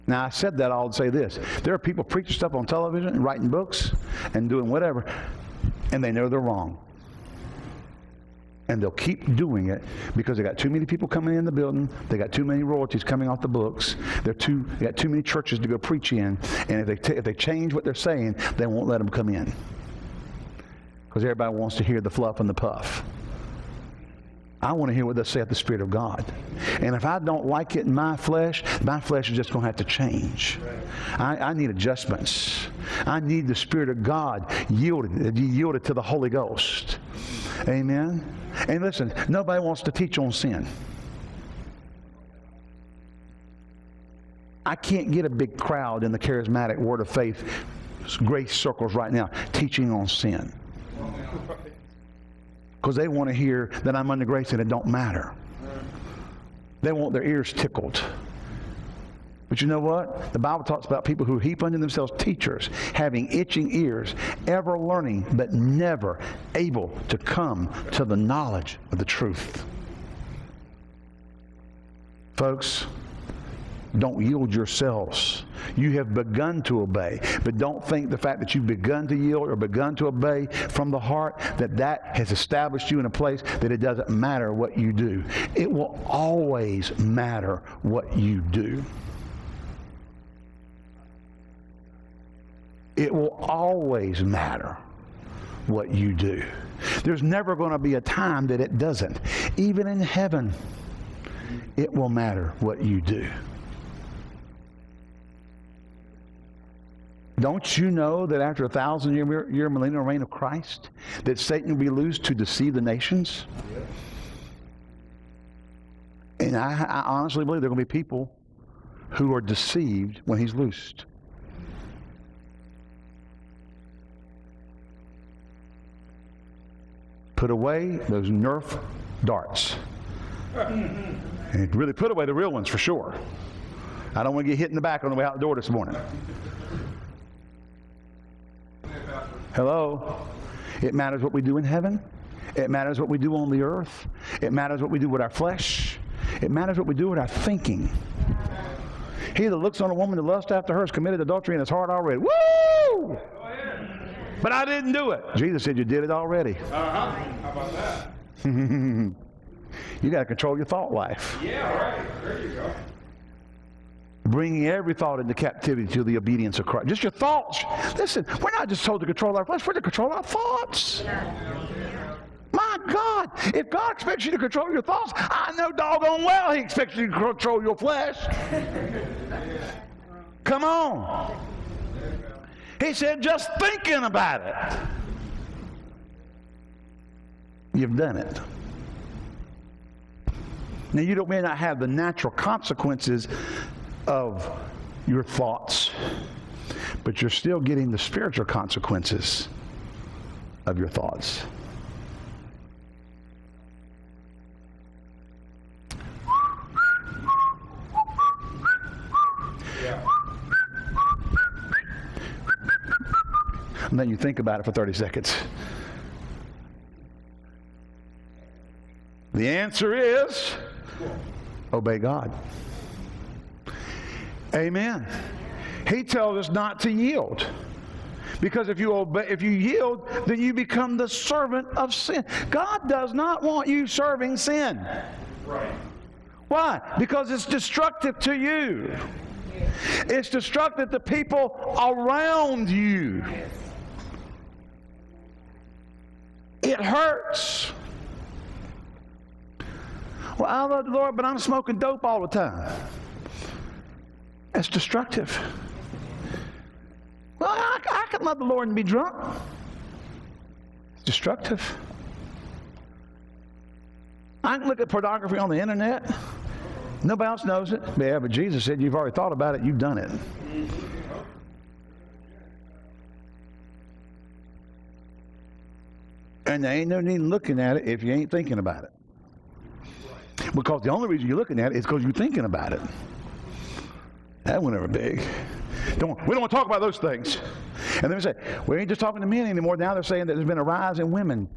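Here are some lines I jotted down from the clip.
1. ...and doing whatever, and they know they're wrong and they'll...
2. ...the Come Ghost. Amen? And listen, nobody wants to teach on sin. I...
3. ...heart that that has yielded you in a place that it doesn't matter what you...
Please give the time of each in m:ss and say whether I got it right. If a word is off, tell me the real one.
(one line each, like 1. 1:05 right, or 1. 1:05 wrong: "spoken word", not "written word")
1. 0:04 right
2. 0:35 wrong: "Holy", not "Come"
3. 1:20 wrong: "established", not "yielded".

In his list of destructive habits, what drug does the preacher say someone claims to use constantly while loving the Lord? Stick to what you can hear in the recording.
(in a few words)
dope.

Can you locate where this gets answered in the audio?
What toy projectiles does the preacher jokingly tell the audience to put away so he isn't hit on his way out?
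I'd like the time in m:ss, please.
2:08.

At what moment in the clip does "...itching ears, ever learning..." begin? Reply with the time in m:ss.
1:03.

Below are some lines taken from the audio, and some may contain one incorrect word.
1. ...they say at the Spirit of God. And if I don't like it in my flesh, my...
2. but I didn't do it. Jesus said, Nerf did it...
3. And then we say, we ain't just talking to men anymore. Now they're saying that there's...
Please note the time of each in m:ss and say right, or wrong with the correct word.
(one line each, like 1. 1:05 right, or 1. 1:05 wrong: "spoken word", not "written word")
1. 0:25 right
2. 2:34 wrong: "You", not "Nerf"
3. 4:48 right.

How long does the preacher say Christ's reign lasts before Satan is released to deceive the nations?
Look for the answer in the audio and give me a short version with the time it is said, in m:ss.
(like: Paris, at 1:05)
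1000 years, at 1:48.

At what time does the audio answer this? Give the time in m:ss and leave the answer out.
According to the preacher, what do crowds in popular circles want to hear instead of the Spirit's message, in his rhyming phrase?
0:21.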